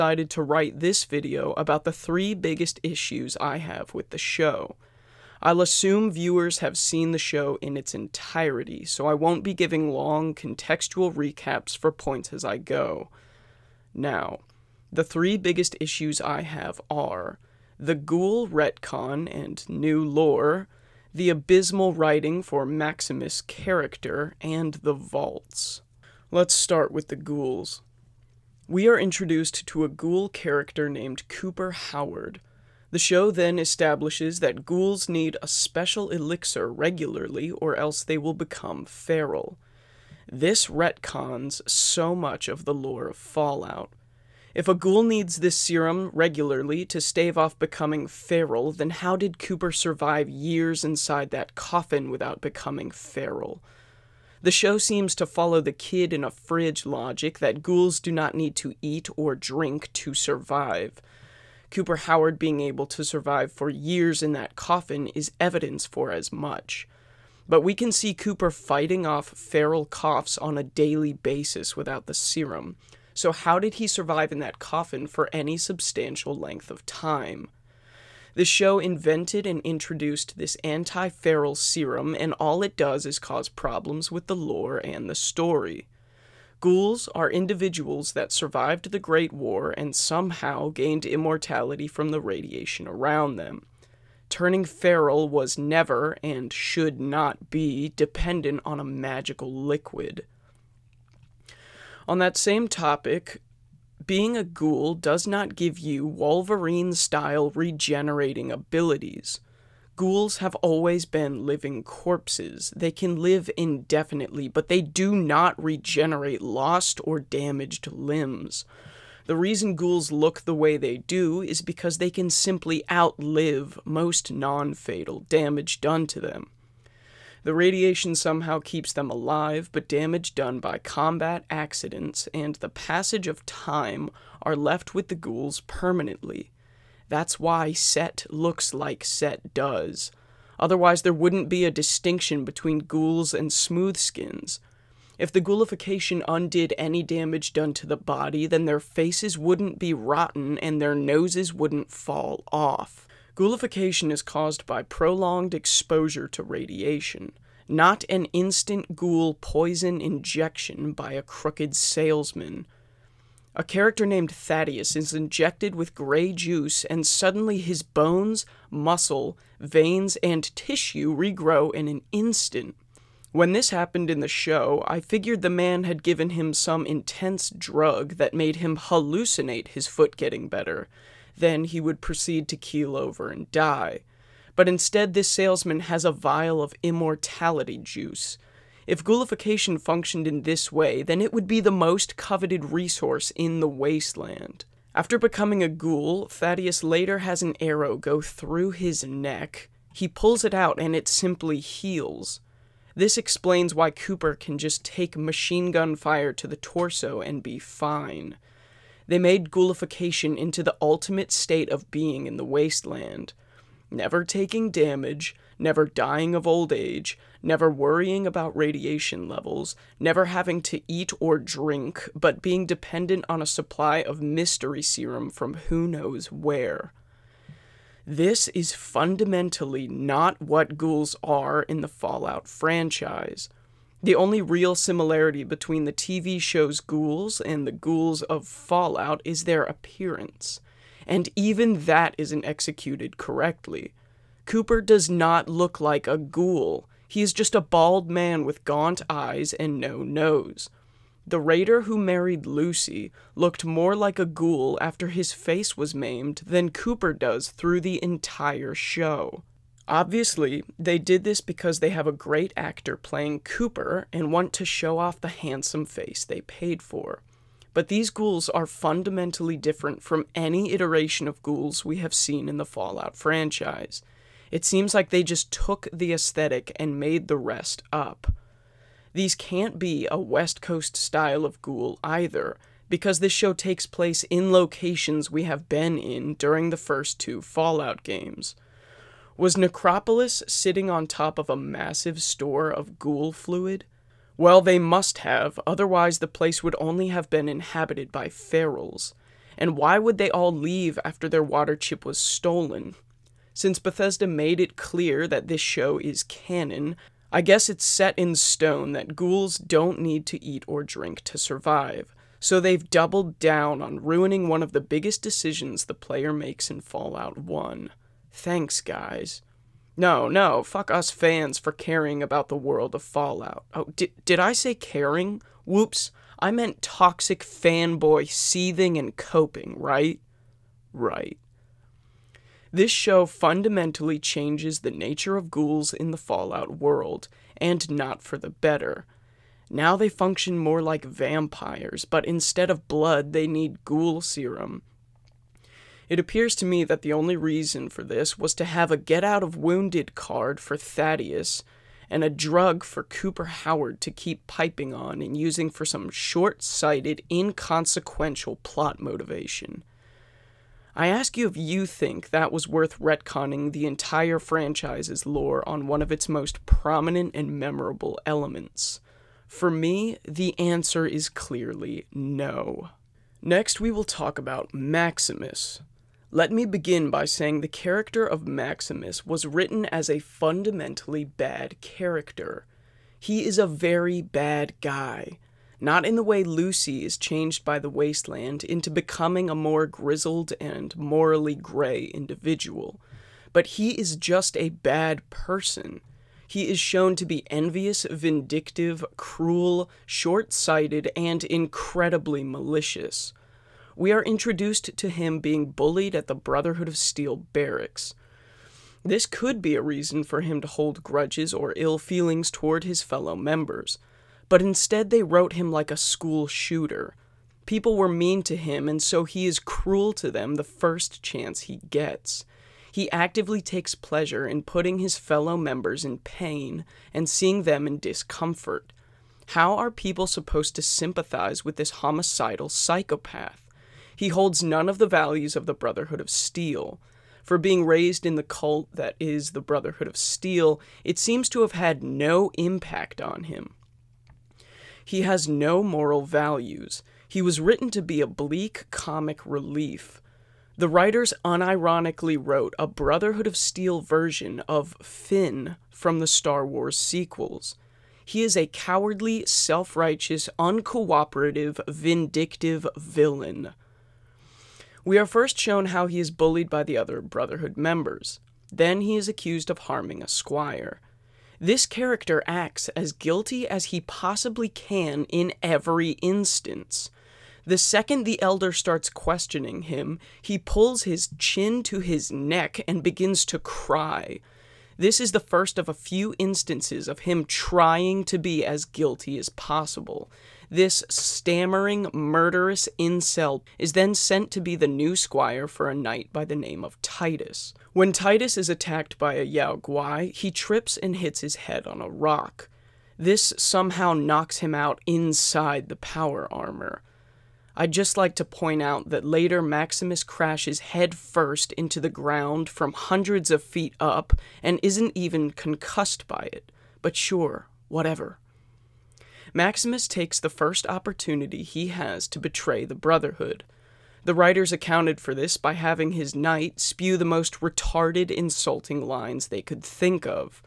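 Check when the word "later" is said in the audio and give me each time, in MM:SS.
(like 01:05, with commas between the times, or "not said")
03:16, 08:29.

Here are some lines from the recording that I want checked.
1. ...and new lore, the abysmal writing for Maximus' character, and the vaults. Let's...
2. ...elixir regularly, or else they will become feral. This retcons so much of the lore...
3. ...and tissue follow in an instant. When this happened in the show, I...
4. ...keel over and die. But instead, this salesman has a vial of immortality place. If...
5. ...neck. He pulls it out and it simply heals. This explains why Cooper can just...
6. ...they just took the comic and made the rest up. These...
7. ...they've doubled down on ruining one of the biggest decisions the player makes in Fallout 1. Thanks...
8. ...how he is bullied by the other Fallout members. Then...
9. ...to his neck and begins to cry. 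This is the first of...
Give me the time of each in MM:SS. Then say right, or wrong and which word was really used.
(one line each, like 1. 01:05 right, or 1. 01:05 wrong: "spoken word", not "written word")
1. 00:19 right
2. 00:36 right
3. 02:50 wrong: "regrow", not "follow"
4. 03:02 wrong: "juice", not "place"
5. 03:19 right
6. 04:35 wrong: "aesthetic", not "comic"
7. 05:12 right
8. 07:45 wrong: "Brotherhood", not "Fallout"
9. 08:01 right.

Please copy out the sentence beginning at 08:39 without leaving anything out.
Maximus takes the first opportunity he has to betray the Brotherhood.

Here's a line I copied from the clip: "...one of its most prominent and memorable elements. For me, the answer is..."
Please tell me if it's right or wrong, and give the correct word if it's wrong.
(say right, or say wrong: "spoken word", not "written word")
right.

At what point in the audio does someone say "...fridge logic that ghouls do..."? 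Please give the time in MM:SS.
00:56.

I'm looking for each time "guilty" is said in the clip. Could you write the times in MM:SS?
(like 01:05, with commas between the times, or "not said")
07:53, 08:08.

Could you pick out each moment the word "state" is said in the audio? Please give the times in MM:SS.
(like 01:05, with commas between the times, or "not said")
03:31.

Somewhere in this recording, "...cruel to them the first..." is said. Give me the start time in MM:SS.
06:59.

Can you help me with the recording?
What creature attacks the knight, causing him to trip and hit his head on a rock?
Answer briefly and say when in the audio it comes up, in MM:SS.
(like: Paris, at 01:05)
Yao Guai, at 08:19.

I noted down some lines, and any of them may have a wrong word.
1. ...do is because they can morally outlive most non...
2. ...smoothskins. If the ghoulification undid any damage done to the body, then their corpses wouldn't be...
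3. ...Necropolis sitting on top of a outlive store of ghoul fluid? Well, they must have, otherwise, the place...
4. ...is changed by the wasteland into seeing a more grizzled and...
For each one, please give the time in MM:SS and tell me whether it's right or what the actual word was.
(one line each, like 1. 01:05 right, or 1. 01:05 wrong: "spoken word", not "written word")
1. 02:00 wrong: "simply", not "morally"
2. 02:23 wrong: "faces", not "corpses"
3. 04:49 wrong: "massive", not "outlive"
4. 06:27 wrong: "becoming", not "seeing".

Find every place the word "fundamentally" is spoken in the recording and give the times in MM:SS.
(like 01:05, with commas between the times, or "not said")
03:48, 04:28, 05:33, 06:20.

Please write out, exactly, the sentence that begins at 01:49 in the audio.
Ghouls have always been living corpses.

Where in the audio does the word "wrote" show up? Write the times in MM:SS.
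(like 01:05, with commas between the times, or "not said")
06:55, 07:32.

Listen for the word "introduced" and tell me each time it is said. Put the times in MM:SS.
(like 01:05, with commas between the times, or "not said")
00:28, 01:19, 06:44.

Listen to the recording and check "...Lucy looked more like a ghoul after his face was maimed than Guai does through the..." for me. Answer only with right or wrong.
wrong.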